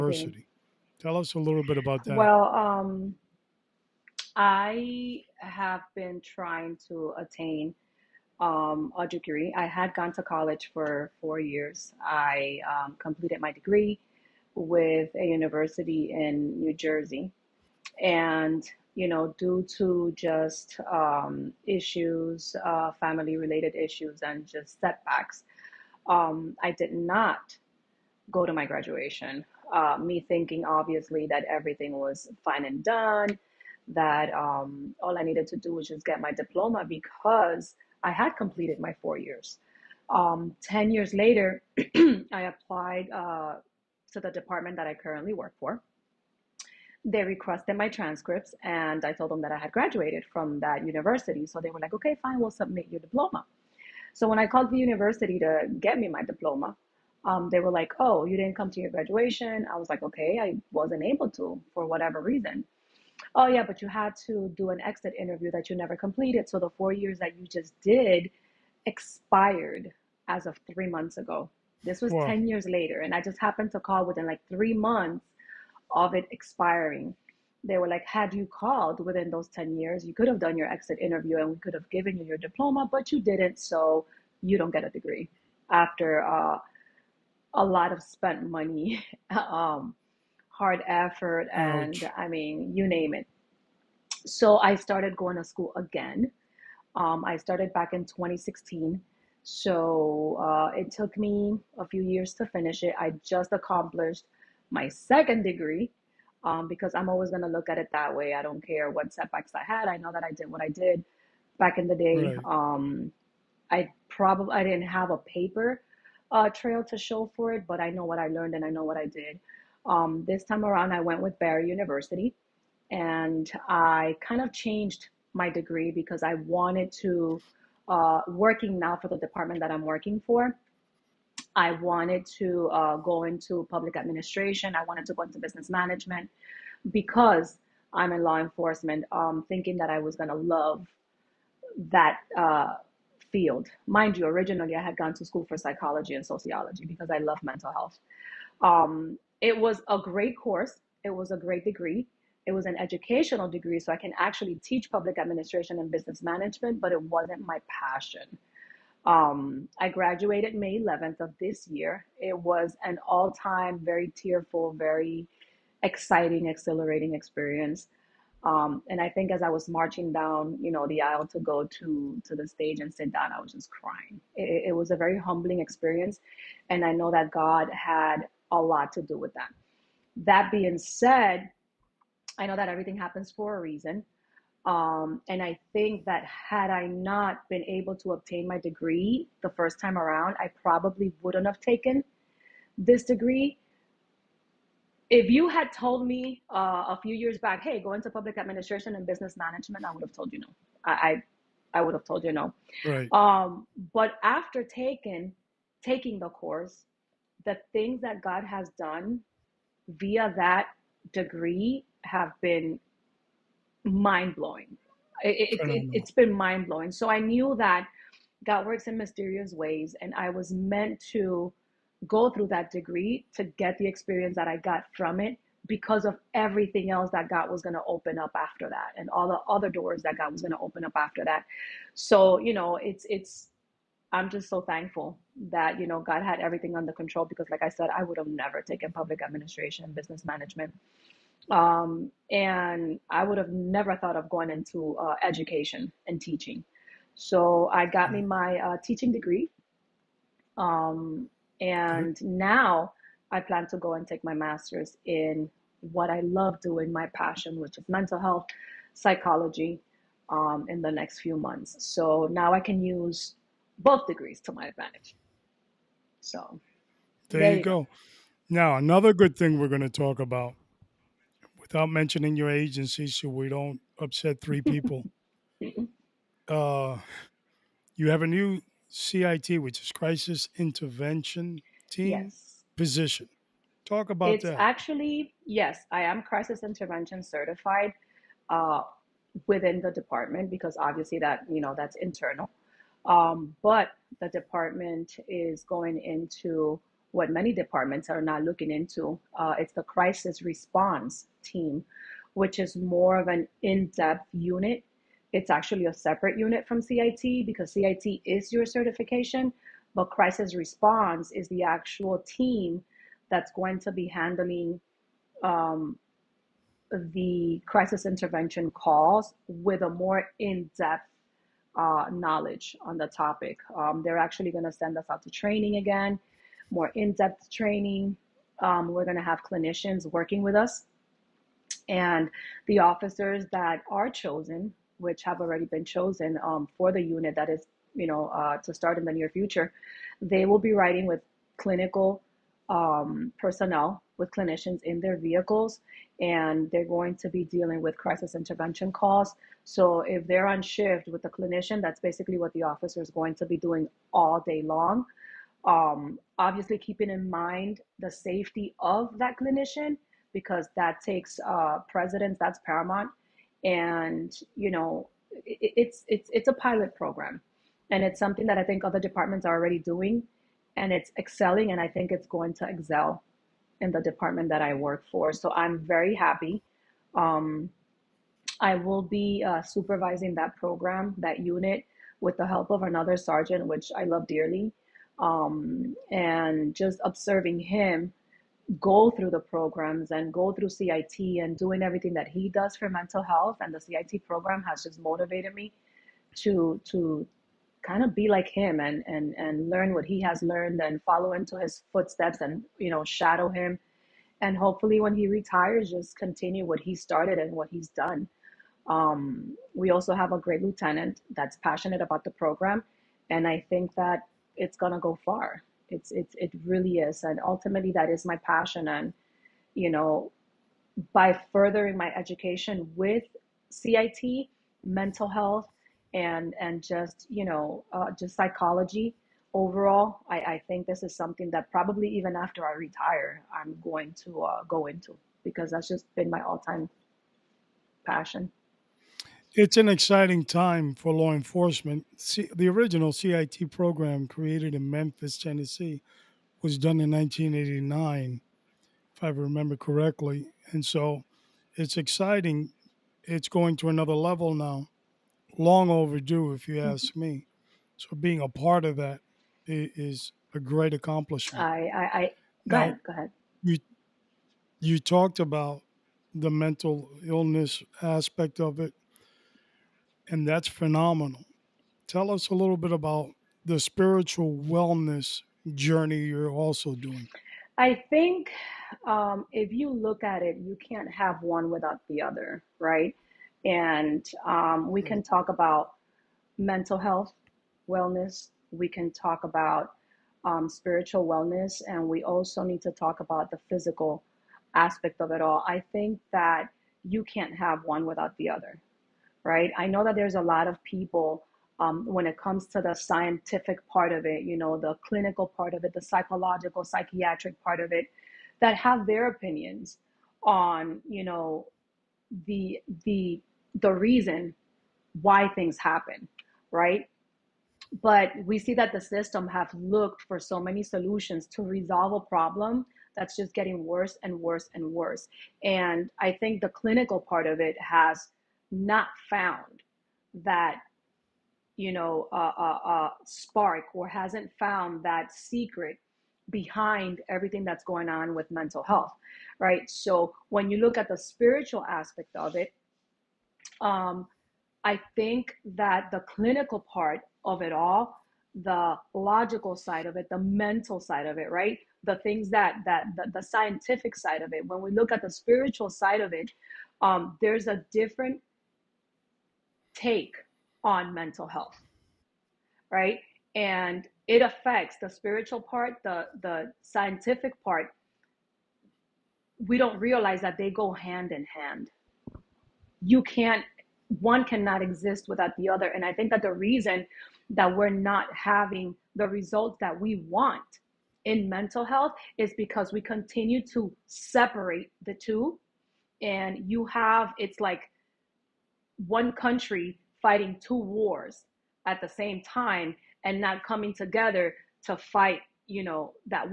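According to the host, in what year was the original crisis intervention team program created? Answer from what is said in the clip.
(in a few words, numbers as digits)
1989.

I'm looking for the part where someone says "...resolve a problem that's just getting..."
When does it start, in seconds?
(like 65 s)
521 s.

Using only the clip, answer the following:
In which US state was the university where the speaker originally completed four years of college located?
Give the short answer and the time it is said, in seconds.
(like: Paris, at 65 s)
New Jersey, at 16 s.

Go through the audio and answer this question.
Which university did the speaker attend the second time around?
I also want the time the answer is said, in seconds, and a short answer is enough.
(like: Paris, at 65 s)
Barry University, at 121 s.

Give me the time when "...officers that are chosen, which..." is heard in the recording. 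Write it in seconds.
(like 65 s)
332 s.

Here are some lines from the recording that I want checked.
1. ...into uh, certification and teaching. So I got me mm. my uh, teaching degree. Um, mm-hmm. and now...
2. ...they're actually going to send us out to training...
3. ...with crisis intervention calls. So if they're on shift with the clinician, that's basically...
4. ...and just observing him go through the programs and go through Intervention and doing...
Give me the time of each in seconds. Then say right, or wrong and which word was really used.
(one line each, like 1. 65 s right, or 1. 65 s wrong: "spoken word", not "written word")
1. 244 s wrong: "education", not "certification"
2. 324 s right
3. 347 s right
4. 386 s wrong: "CIT", not "Intervention".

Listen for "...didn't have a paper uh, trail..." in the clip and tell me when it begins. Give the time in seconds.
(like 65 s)
114 s.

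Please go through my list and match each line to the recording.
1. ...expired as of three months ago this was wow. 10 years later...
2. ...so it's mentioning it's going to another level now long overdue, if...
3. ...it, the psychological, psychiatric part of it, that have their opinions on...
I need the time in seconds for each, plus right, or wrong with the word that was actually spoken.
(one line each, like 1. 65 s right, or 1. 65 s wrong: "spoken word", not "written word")
1. 68 s right
2. 450 s wrong: "exciting", not "mentioning"
3. 505 s right.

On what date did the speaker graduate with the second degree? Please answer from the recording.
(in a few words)
May 11.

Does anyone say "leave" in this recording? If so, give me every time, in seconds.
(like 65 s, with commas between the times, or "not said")
not said.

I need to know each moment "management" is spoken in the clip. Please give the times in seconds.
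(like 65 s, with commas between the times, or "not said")
135 s, 156 s, 199 s, 240 s.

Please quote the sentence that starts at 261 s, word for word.
So now I can use both degrees to my advantage.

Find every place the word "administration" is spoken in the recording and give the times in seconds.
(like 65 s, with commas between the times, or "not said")
133 s, 155 s, 198 s, 239 s.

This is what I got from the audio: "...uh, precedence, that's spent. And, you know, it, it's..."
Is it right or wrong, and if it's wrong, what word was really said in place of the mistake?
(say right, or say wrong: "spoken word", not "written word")
wrong: "paramount", not "spent".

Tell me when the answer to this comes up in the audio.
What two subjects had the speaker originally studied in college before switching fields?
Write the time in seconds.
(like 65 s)
145 s.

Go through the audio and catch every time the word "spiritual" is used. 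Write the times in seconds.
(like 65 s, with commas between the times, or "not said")
473 s, 490 s, 541 s, 555 s, 565 s.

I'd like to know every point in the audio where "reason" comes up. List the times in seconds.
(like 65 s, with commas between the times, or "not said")
62 s, 183 s, 513 s, 576 s.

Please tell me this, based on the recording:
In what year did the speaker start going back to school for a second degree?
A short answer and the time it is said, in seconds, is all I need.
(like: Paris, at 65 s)
2016, at 98 s.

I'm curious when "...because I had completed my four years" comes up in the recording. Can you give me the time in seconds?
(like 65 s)
36 s.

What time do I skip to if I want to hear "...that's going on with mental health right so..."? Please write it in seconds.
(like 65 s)
537 s.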